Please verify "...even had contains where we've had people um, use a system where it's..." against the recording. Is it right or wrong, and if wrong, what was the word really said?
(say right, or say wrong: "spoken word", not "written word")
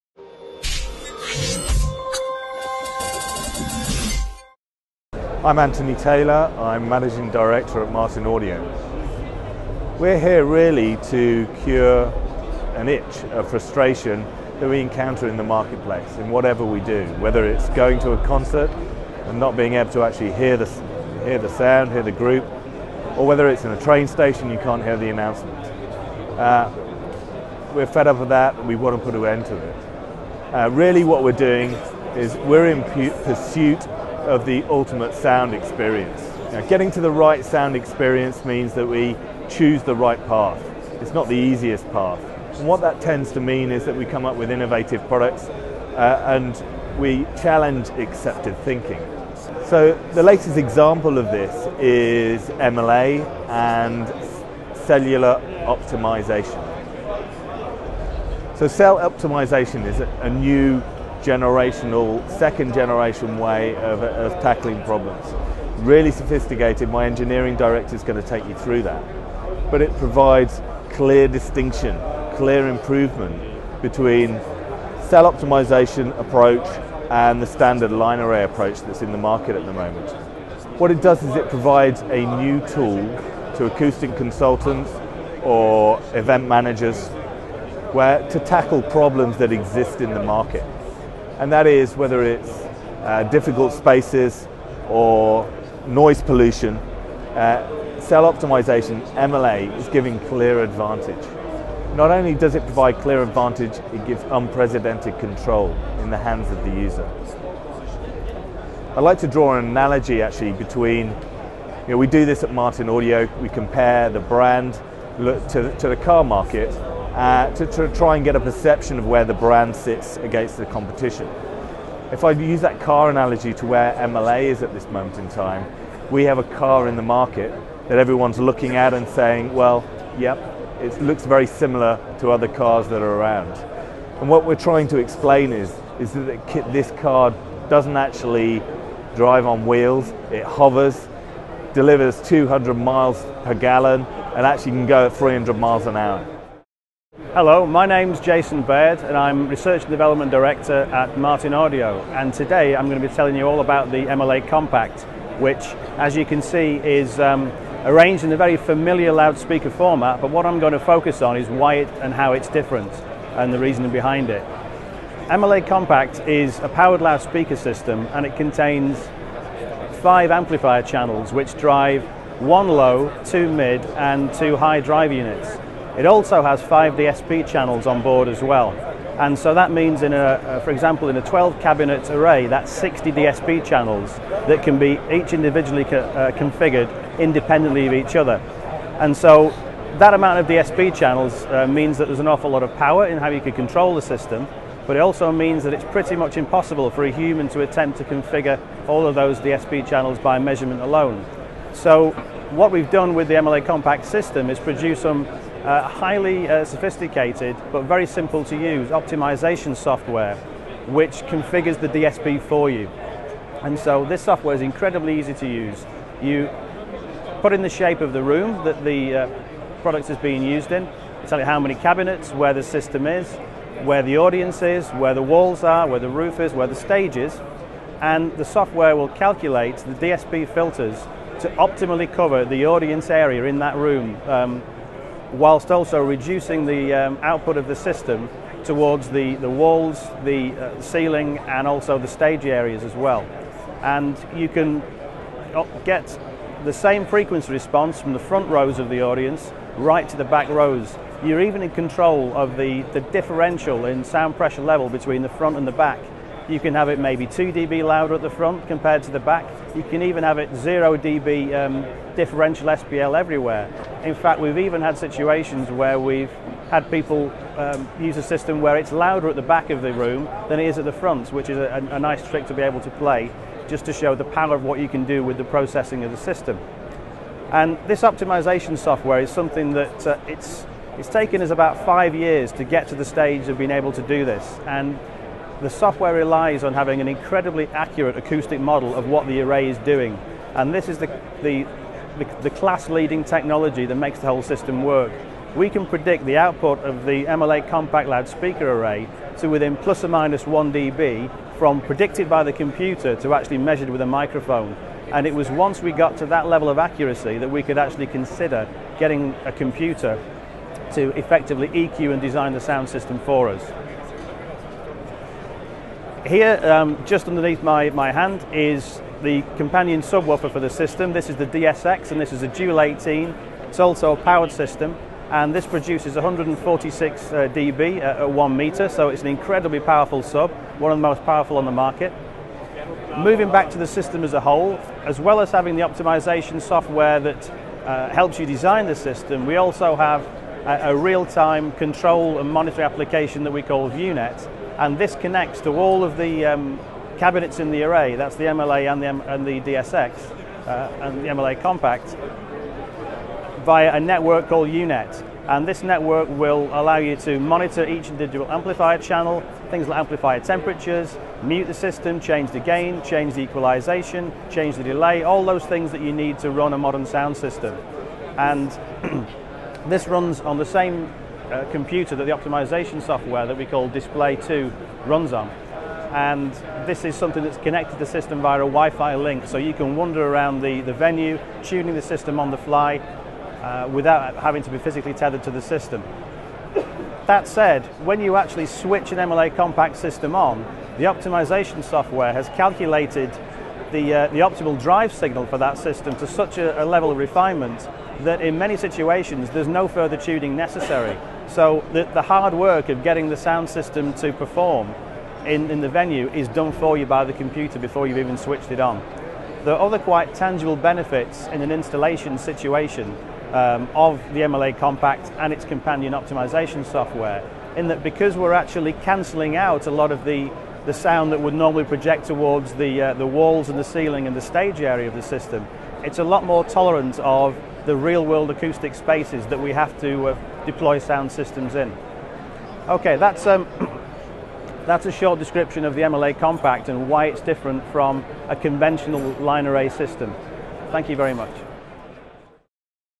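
wrong: "situations", not "contains".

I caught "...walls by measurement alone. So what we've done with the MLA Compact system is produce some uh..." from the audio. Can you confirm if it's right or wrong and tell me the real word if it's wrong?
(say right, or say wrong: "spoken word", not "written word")
wrong: "channels", not "walls".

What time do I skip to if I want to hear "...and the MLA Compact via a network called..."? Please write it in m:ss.
5:51.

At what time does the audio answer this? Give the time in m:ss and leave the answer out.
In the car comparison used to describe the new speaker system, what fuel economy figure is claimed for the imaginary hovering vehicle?
2:22.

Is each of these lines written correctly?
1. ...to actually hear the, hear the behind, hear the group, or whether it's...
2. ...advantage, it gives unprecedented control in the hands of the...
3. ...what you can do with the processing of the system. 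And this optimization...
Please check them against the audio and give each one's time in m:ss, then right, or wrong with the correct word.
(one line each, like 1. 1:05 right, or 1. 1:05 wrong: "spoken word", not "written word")
1. 0:19 wrong: "sound", not "behind"
2. 1:43 right
3. 4:34 right.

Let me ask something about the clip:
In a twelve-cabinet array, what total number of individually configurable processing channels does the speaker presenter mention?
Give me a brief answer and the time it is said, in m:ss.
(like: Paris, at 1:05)
60, at 3:02.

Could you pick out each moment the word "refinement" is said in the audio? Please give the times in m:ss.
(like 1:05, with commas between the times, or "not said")
6:37.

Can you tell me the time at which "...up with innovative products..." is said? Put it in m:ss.
0:44.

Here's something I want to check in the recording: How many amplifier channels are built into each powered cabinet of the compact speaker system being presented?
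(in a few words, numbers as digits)
5.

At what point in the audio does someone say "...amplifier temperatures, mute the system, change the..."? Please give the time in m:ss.
5:59.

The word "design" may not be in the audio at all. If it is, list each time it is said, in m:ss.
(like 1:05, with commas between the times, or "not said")
5:12, 5:38.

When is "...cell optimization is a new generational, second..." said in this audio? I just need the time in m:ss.
0:58.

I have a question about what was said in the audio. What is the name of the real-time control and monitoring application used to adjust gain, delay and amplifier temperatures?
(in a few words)
VU-NET.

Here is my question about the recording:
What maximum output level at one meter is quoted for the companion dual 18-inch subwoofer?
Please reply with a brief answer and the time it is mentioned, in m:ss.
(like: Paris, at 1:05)
146 dB, at 5:26.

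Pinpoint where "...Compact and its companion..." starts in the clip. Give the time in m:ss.
6:54.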